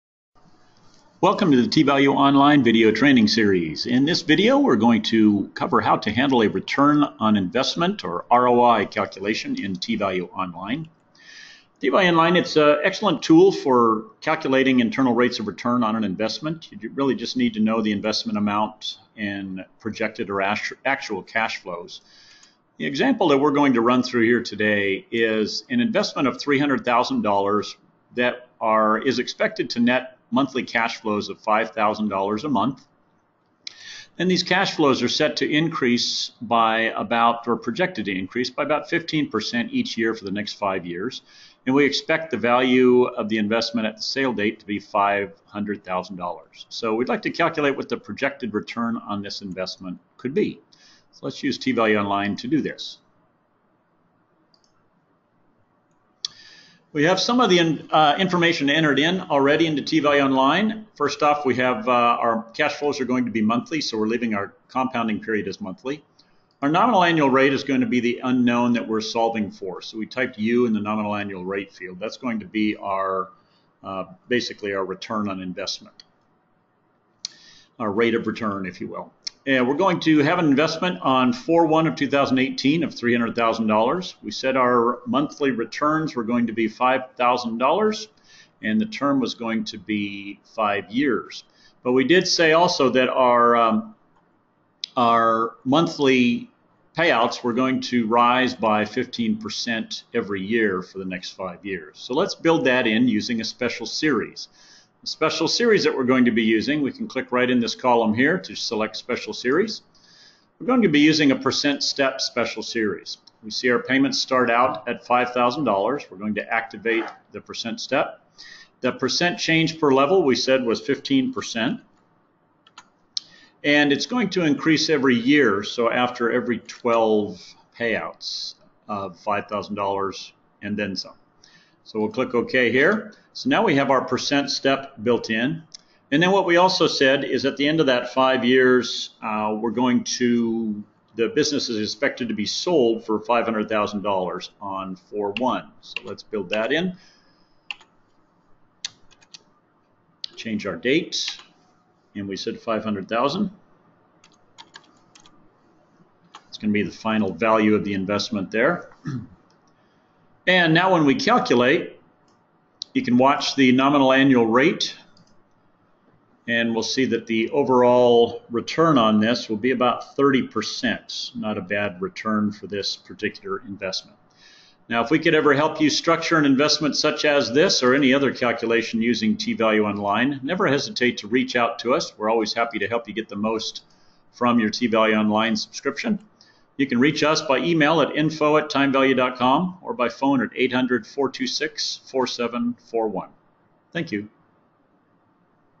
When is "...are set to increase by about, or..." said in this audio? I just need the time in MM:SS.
00:35.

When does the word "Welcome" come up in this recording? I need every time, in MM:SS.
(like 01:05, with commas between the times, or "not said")
00:01.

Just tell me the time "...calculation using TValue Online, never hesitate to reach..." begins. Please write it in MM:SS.
02:58.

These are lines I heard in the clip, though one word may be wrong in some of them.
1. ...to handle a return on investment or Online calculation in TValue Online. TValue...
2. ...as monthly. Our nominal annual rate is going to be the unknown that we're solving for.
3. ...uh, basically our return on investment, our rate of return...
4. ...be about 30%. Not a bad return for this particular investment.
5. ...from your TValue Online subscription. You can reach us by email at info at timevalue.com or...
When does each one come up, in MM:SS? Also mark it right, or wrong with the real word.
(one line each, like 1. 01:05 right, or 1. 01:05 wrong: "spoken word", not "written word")
1. 00:05 wrong: "ROI", not "Online"
2. 01:05 right
3. 01:13 right
4. 02:49 right
5. 03:04 right.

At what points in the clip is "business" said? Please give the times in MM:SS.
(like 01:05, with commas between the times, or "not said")
02:21.